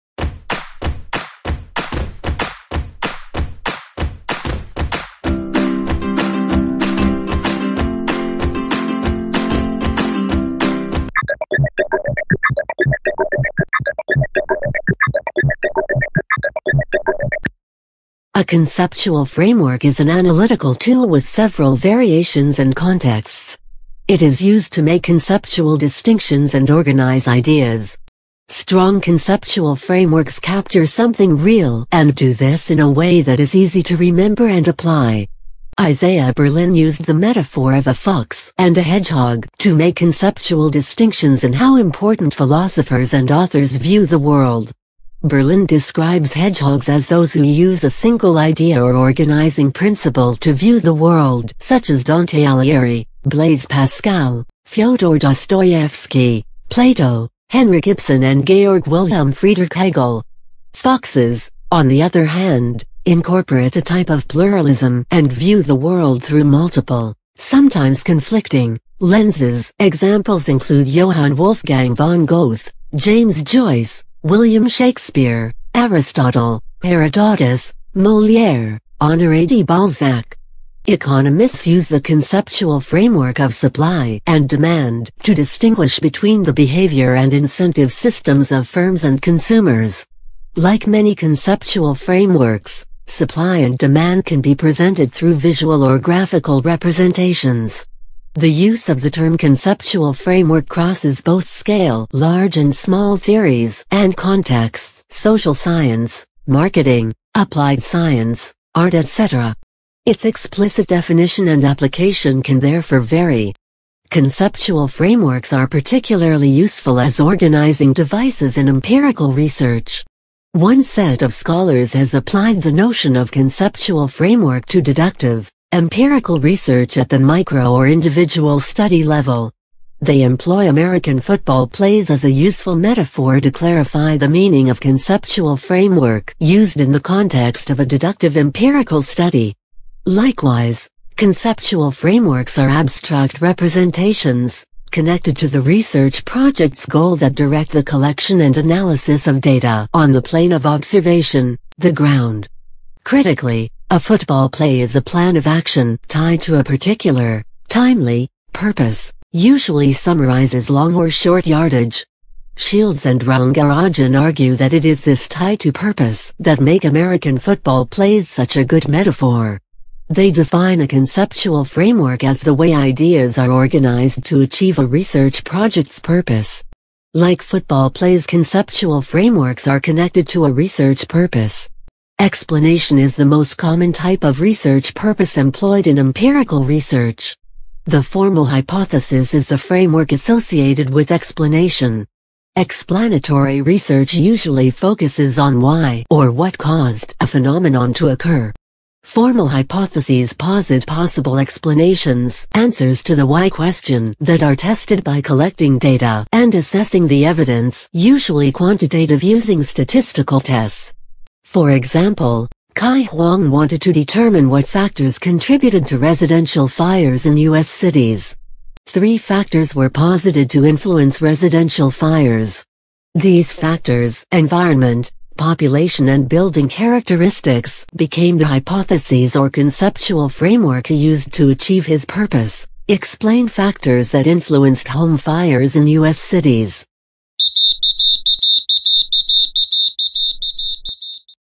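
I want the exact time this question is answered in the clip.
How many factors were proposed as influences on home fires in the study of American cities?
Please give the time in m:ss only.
3:38.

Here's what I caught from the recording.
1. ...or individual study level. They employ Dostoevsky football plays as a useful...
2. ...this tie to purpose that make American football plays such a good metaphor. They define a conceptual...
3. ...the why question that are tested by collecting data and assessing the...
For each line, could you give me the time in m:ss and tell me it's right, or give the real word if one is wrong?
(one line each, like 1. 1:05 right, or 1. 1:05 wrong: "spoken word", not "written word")
1. 2:07 wrong: "American", not "Dostoevsky"
2. 2:45 right
3. 3:23 right.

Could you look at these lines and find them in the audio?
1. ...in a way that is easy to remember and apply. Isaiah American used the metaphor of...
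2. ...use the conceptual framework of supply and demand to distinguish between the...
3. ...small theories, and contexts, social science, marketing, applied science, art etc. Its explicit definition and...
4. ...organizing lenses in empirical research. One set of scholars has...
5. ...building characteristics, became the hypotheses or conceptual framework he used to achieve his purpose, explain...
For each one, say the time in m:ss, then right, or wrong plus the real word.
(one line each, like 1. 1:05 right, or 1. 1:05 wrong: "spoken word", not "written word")
1. 0:32 wrong: "Berlin", not "American"
2. 1:21 right
3. 1:42 right
4. 1:57 wrong: "devices", not "lenses"
5. 3:46 right.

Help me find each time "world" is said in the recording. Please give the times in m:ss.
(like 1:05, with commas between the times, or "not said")
0:44, 0:50, 1:05.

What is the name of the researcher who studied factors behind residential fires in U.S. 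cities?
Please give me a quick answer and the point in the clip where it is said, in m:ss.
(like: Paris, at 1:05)
Kai Huang, at 3:32.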